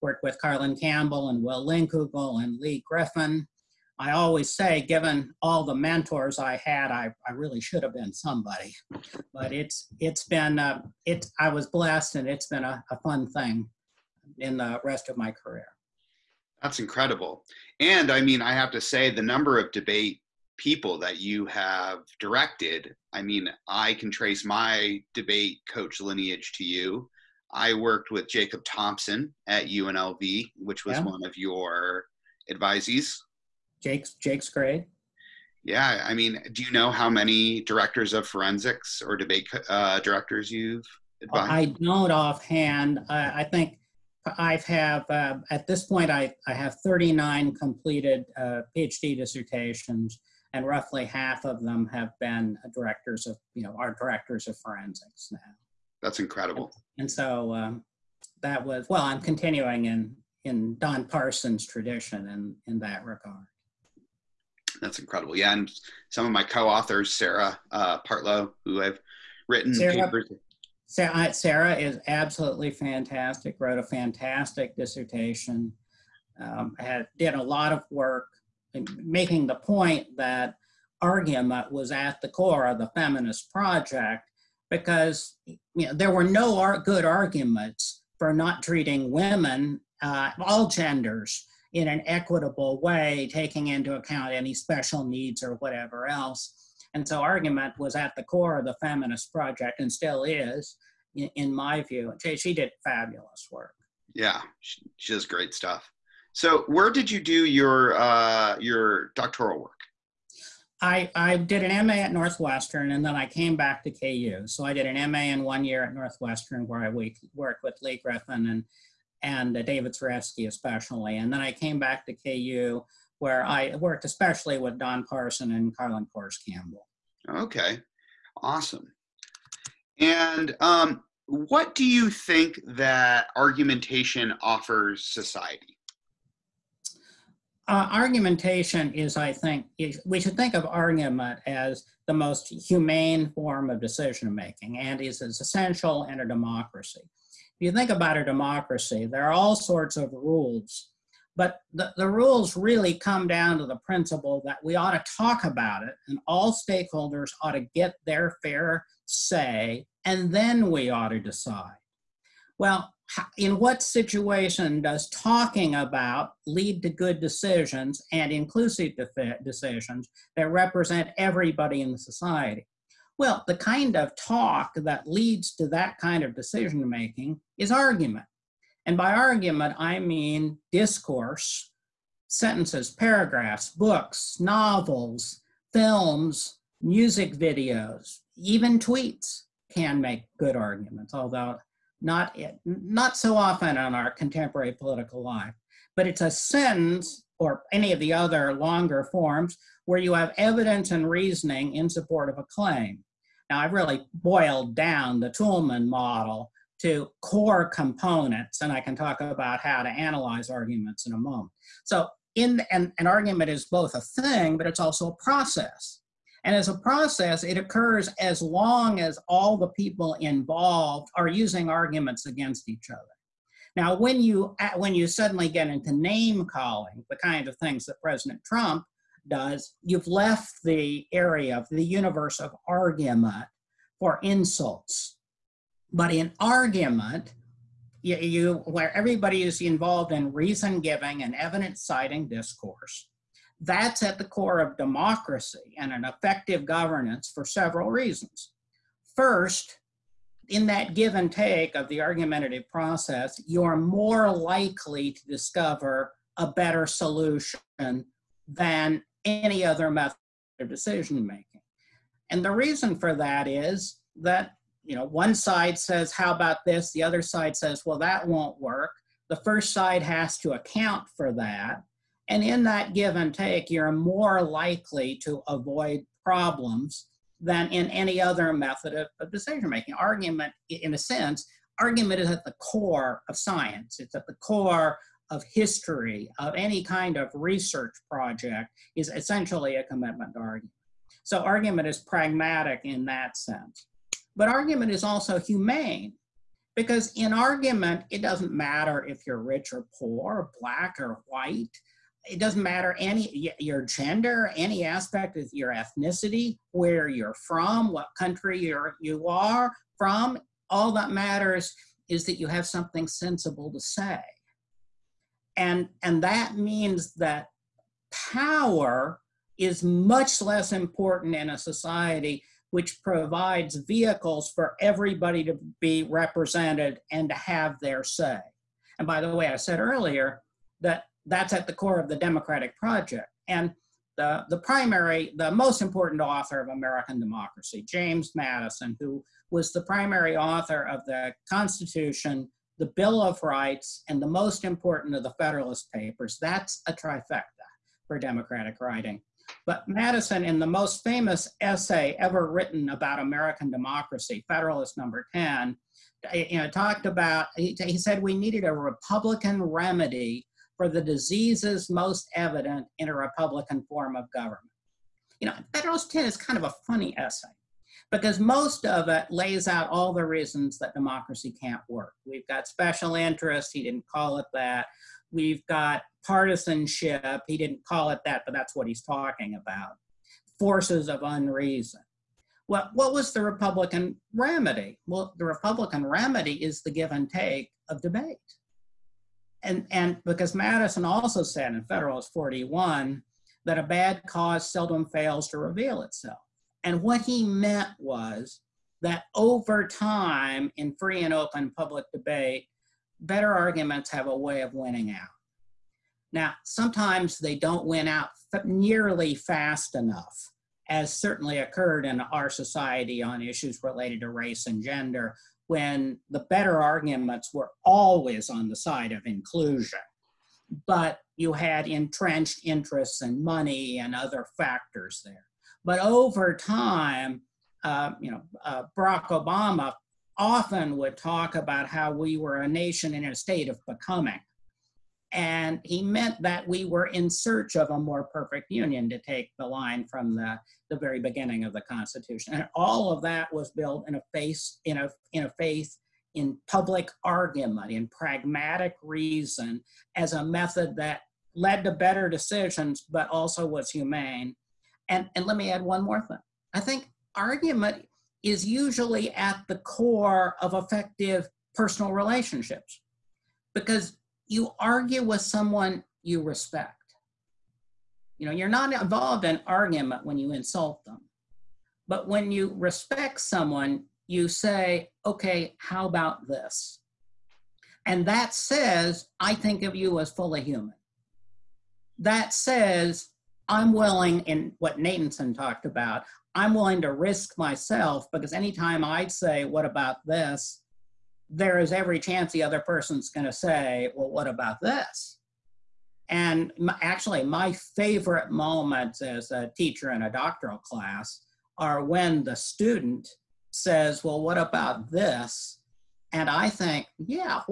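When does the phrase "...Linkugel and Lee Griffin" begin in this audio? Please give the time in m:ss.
0:01.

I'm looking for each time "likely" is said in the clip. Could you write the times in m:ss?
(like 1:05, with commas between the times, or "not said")
4:14, 4:34.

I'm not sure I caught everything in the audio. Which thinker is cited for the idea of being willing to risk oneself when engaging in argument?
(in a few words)
Natanson.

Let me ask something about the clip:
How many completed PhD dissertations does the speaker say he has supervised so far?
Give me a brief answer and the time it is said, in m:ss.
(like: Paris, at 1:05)
39, at 0:46.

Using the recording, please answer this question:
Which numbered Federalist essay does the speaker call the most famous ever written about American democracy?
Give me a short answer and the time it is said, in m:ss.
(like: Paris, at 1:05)
Federalist 10, at 5:54.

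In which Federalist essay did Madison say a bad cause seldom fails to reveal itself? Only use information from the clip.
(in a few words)
Federalist 41.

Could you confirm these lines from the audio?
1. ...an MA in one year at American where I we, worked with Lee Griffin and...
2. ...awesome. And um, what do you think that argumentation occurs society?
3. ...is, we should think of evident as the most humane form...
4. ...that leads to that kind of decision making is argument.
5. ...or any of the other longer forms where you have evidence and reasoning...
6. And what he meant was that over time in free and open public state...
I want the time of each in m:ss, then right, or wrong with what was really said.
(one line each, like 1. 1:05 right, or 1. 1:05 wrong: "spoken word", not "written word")
1. 1:54 wrong: "Northwestern", not "American"
2. 2:08 wrong: "offers", not "occurs"
3. 2:19 wrong: "argument", not "evident"
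4. 2:54 right
5. 3:17 right
6. 6:36 wrong: "debate", not "state".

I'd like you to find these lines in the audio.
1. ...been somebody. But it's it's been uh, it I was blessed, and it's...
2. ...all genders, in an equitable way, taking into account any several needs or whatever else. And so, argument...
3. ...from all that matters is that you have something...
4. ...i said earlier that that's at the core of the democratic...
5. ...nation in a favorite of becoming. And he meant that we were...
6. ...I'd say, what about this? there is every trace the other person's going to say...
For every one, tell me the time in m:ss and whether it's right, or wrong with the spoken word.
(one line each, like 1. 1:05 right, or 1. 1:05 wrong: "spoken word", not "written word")
1. 0:07 right
2. 1:30 wrong: "special", not "several"
3. 5:09 right
4. 5:29 right
5. 7:12 wrong: "state", not "favorite"
6. 8:09 wrong: "chance", not "trace".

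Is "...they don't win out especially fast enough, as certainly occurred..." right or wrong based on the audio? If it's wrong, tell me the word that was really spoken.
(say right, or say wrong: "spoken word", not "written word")
wrong: "nearly", not "especially".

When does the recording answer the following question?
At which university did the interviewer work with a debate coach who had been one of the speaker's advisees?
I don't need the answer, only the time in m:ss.
0:29.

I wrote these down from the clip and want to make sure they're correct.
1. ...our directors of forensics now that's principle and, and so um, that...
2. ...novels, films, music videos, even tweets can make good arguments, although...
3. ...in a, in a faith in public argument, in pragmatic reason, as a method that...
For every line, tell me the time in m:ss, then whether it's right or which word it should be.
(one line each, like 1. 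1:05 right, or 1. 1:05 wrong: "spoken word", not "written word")
1. 0:53 wrong: "incredible", not "principle"
2. 3:04 right
3. 7:24 right.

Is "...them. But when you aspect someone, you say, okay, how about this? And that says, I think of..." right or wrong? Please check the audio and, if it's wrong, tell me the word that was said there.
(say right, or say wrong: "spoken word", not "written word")
wrong: "respect", not "aspect".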